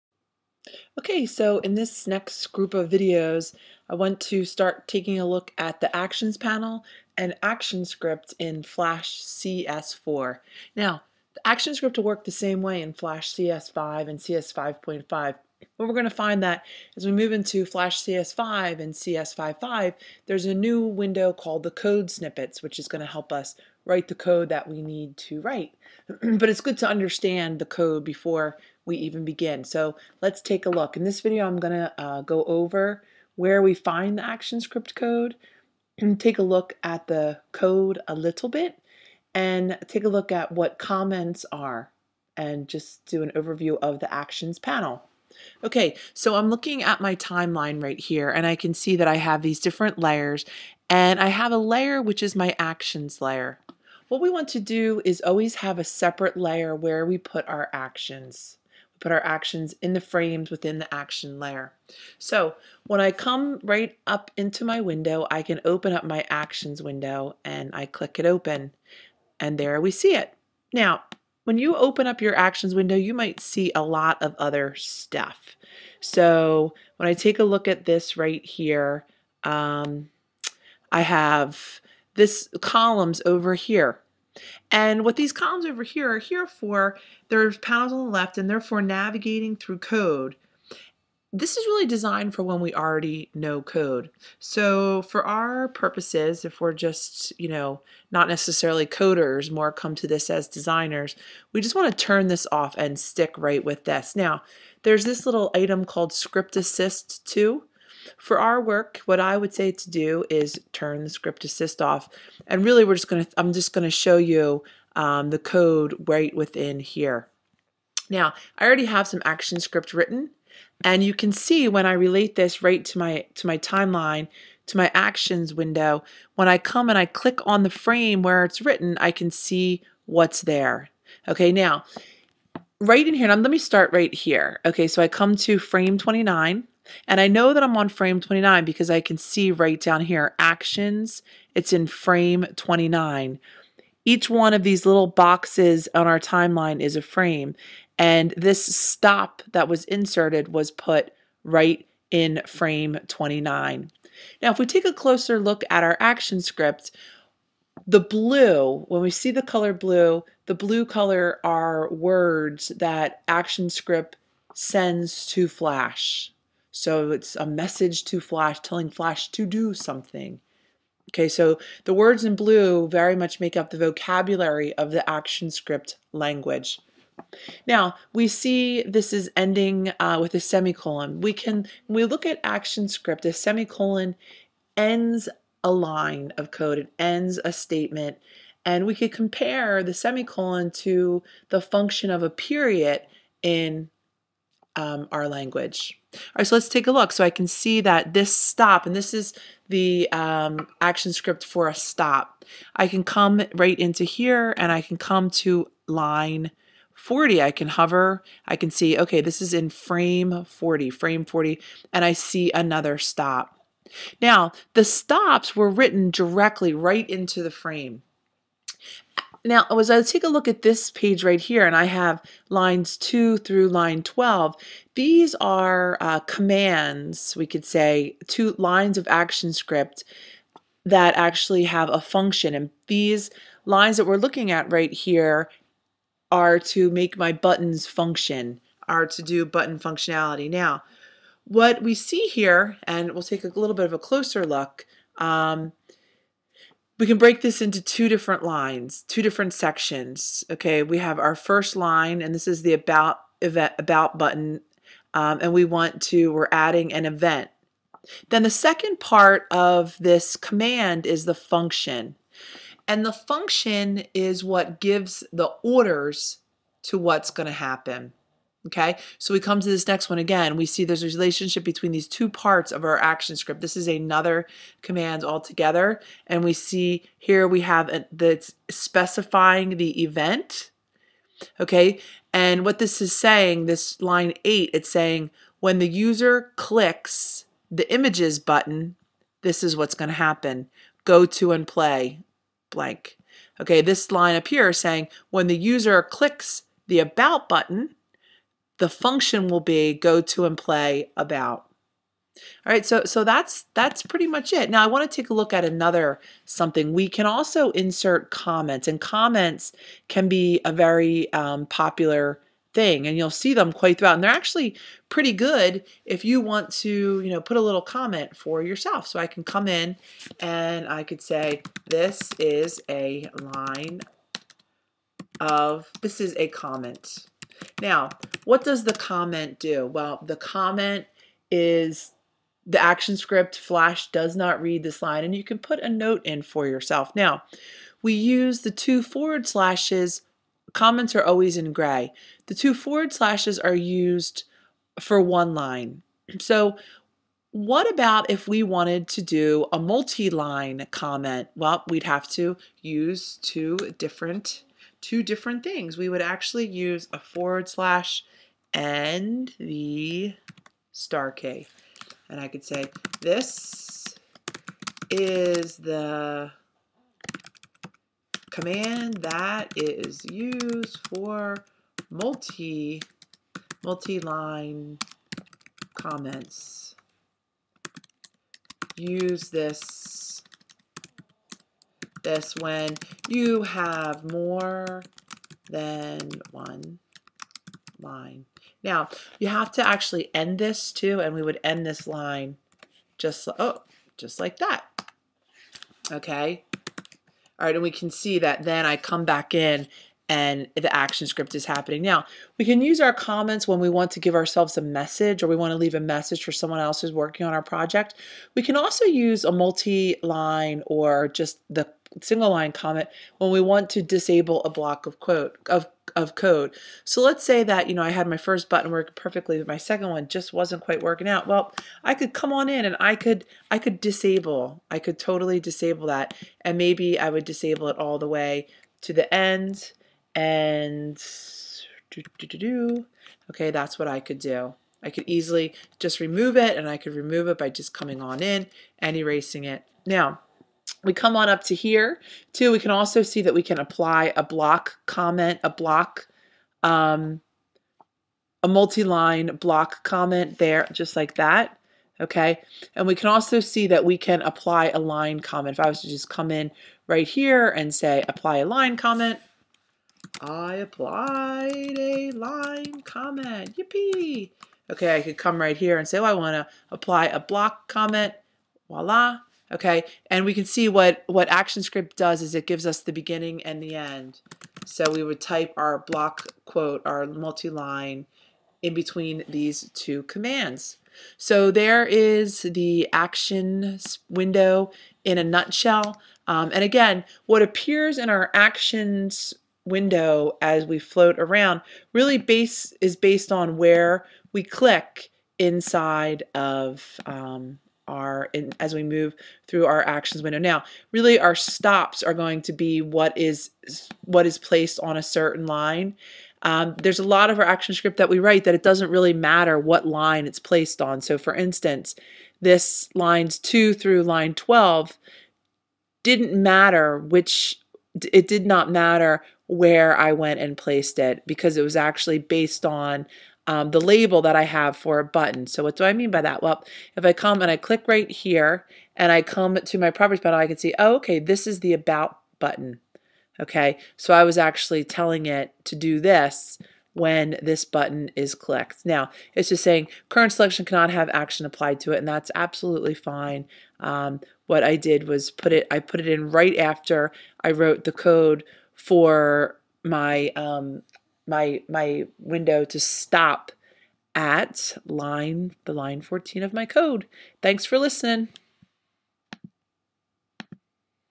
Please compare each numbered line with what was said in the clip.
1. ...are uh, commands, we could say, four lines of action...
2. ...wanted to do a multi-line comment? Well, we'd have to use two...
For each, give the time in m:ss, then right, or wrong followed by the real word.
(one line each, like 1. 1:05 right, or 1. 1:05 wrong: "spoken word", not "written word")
1. 3:45 wrong: "two", not "four"
2. 5:48 right.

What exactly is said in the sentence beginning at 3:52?
And these lines that we're looking at right here are to make my buttons function, are to do button functionality.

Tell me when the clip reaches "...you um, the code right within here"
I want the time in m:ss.
1:54.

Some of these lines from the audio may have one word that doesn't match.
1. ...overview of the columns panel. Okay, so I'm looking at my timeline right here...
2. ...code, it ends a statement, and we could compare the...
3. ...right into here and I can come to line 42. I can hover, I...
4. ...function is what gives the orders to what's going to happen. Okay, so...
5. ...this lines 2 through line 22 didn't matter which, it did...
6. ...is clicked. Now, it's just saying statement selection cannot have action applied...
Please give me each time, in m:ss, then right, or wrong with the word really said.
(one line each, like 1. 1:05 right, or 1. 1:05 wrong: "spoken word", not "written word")
1. 0:43 wrong: "actions", not "columns"
2. 3:06 right
3. 3:23 wrong: "40", not "42"
4. 4:23 right
5. 8:32 wrong: "12", not "22"
6. 8:58 wrong: "current", not "statement".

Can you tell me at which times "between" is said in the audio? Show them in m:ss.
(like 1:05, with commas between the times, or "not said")
4:31, 7:58.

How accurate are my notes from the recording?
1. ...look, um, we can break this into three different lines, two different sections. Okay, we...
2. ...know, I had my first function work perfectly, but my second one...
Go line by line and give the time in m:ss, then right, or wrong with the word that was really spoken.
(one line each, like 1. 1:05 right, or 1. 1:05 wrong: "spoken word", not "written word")
1. 4:04 wrong: "two", not "three"
2. 6:57 wrong: "button", not "function".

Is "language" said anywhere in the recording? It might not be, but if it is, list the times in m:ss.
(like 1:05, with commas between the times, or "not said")
2:56, 3:15.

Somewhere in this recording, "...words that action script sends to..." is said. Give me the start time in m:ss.
2:41.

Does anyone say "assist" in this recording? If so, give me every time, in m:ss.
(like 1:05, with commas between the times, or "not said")
1:46, 1:51.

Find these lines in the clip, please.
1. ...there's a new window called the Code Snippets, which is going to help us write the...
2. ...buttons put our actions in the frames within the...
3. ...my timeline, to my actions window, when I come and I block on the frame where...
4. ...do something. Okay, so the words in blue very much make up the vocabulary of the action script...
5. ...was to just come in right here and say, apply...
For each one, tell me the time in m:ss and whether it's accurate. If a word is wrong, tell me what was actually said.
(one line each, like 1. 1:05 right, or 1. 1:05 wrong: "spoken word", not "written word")
1. 0:20 right
2. 0:57 wrong: "actions", not "buttons"
3. 2:03 wrong: "click", not "block"
4. 2:49 right
5. 7:35 right.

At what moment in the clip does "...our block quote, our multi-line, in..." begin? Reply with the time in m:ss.
7:55.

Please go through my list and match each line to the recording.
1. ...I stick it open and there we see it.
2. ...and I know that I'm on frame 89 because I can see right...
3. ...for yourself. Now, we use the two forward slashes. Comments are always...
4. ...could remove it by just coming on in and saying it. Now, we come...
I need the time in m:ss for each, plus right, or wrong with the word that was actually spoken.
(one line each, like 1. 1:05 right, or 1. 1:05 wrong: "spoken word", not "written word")
1. 1:07 wrong: "click", not "stick"
2. 2:17 wrong: "29", not "89"
3. 5:36 right
4. 7:16 wrong: "erasing", not "saying".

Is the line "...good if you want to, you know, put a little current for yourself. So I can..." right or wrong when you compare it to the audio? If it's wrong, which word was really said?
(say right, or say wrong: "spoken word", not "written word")
wrong: "comment", not "current".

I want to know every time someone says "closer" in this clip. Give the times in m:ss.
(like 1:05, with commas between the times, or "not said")
2:34, 4:03.